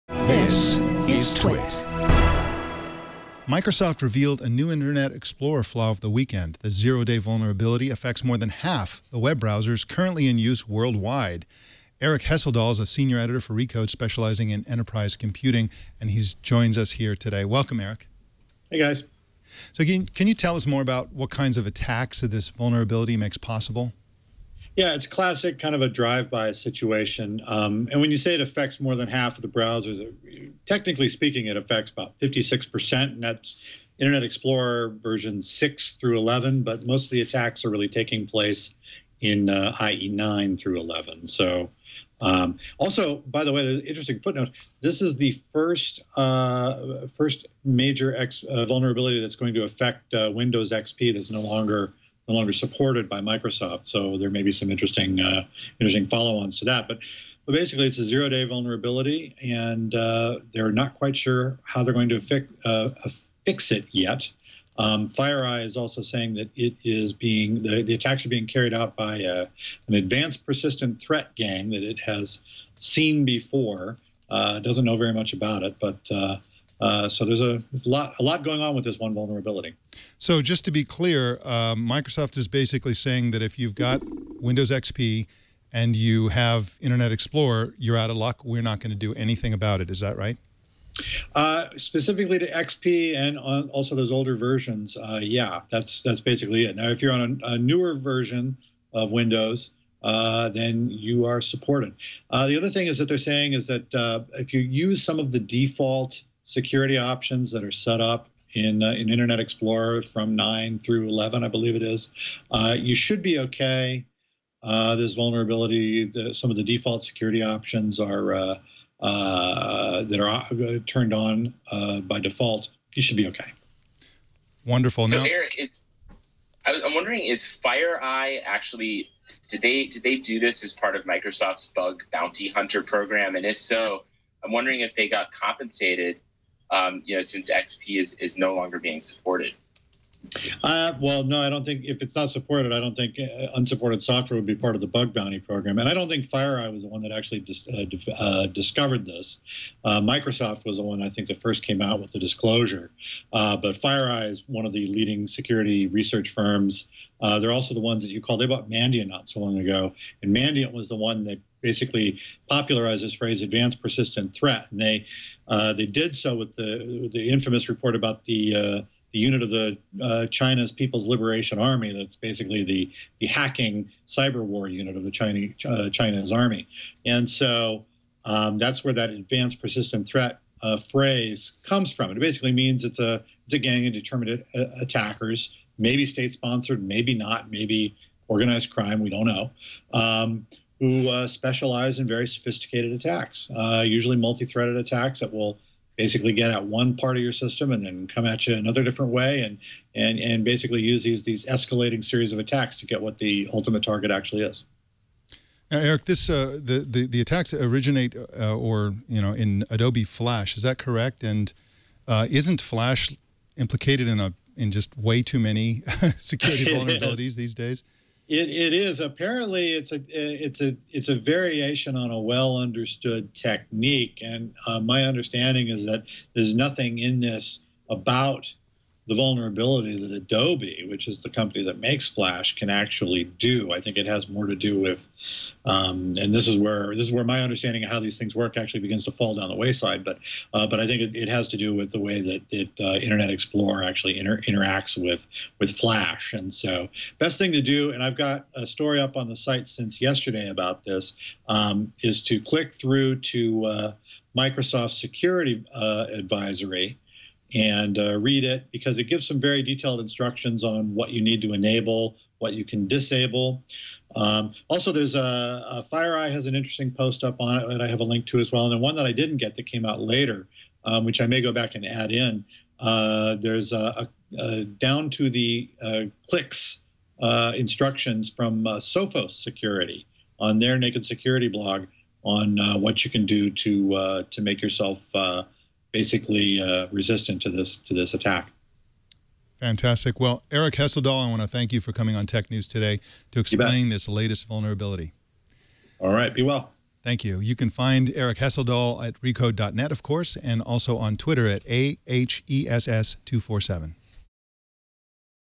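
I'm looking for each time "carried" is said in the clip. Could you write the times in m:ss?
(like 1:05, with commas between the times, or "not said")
1:08.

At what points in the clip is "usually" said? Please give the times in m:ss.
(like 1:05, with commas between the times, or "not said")
3:13.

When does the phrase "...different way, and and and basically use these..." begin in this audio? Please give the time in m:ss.
3:18.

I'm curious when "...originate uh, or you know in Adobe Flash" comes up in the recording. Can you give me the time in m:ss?
3:27.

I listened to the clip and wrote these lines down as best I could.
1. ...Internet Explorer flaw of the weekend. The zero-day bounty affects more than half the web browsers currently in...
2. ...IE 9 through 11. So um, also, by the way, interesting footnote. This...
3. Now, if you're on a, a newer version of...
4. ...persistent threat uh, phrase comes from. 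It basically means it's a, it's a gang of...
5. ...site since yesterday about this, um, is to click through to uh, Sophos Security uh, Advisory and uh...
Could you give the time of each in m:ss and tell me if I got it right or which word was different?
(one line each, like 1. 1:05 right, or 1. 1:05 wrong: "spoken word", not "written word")
1. 0:04 wrong: "vulnerability", not "bounty"
2. 0:39 right
3. 1:36 right
4. 2:59 right
5. 4:09 wrong: "Microsoft", not "Sophos".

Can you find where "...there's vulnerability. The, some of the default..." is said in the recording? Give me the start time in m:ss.
1:54.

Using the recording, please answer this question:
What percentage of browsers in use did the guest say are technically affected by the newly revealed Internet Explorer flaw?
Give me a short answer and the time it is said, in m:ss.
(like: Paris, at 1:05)
56%, at 0:32.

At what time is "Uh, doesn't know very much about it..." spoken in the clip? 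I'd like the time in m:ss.
1:14.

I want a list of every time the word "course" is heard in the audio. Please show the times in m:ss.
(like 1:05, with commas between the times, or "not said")
5:00.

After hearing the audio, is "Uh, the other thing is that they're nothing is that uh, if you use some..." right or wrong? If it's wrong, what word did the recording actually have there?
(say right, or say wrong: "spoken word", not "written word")
wrong: "saying", not "nothing".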